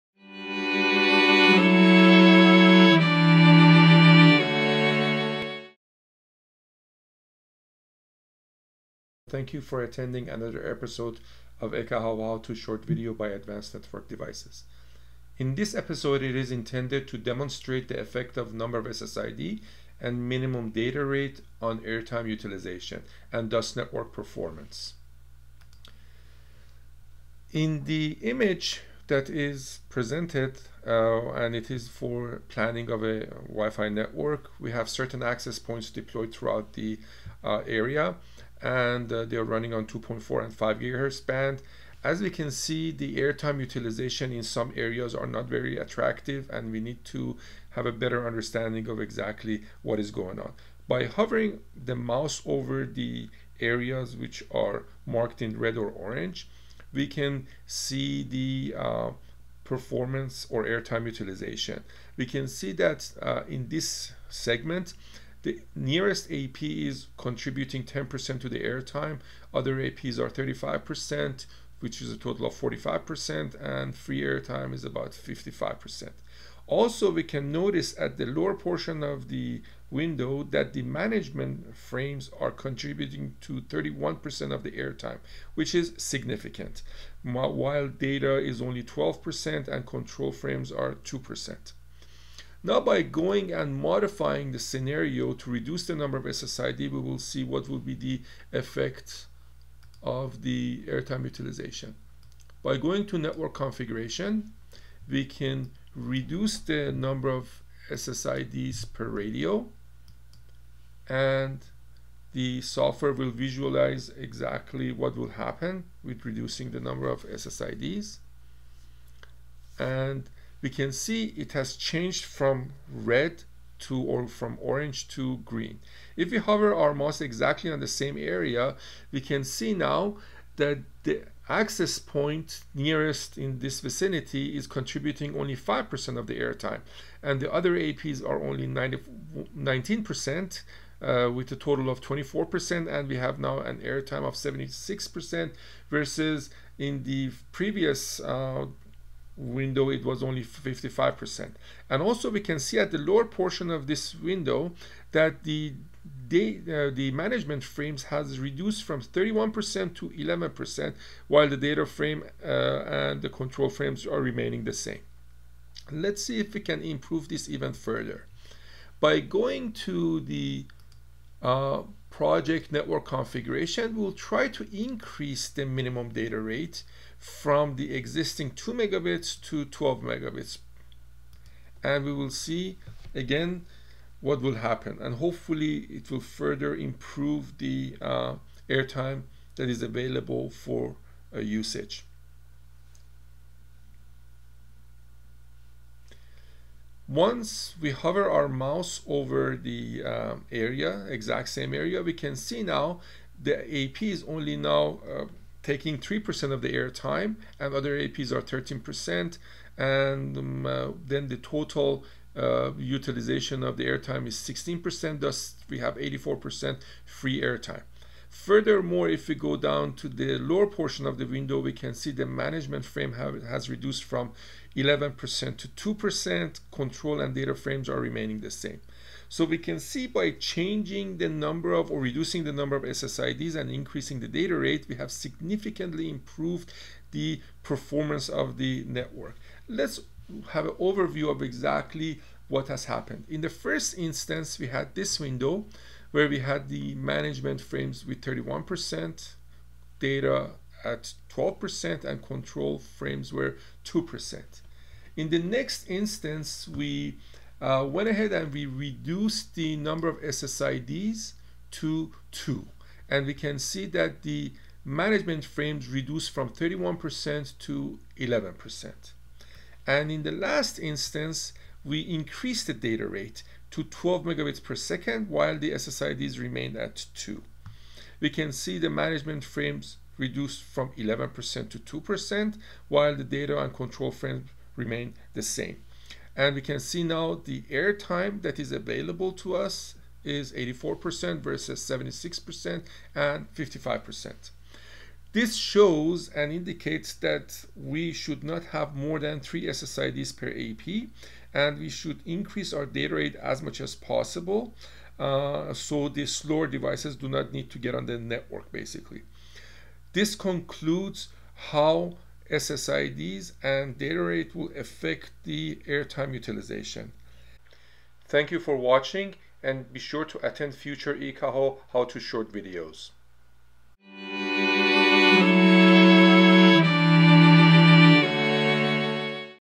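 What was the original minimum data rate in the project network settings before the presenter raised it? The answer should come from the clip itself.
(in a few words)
2 megabits.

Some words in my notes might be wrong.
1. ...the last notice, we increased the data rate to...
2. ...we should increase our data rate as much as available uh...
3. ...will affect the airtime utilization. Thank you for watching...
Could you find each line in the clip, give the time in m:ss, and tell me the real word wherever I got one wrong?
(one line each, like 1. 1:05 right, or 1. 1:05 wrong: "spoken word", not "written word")
1. 4:30 wrong: "instance", not "notice"
2. 5:01 wrong: "possible", not "available"
3. 5:14 right.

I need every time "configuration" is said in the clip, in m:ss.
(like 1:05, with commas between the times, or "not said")
1:43, 2:53.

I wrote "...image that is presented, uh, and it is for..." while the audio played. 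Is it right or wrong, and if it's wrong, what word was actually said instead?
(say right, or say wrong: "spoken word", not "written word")
right.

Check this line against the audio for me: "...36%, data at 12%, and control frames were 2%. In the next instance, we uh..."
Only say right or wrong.
wrong.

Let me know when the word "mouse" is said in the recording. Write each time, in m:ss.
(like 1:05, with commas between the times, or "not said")
0:51, 2:06, 3:18.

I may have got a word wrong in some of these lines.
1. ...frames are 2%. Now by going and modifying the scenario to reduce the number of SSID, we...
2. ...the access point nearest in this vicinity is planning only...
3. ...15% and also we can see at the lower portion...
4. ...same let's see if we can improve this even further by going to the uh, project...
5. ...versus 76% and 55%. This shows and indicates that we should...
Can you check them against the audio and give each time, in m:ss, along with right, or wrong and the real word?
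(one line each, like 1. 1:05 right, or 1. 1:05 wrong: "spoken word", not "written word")
1. 1:30 right
2. 2:11 wrong: "contributing", not "planning"
3. 2:30 wrong: "55", not "15"
4. 2:44 right
5. 4:51 right.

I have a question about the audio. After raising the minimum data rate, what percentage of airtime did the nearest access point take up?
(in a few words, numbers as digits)
3%.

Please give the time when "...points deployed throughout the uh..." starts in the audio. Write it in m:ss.
0:35.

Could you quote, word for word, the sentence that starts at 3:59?
Let's have an overview of exactly what has happened.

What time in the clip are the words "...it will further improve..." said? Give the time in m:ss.
3:05.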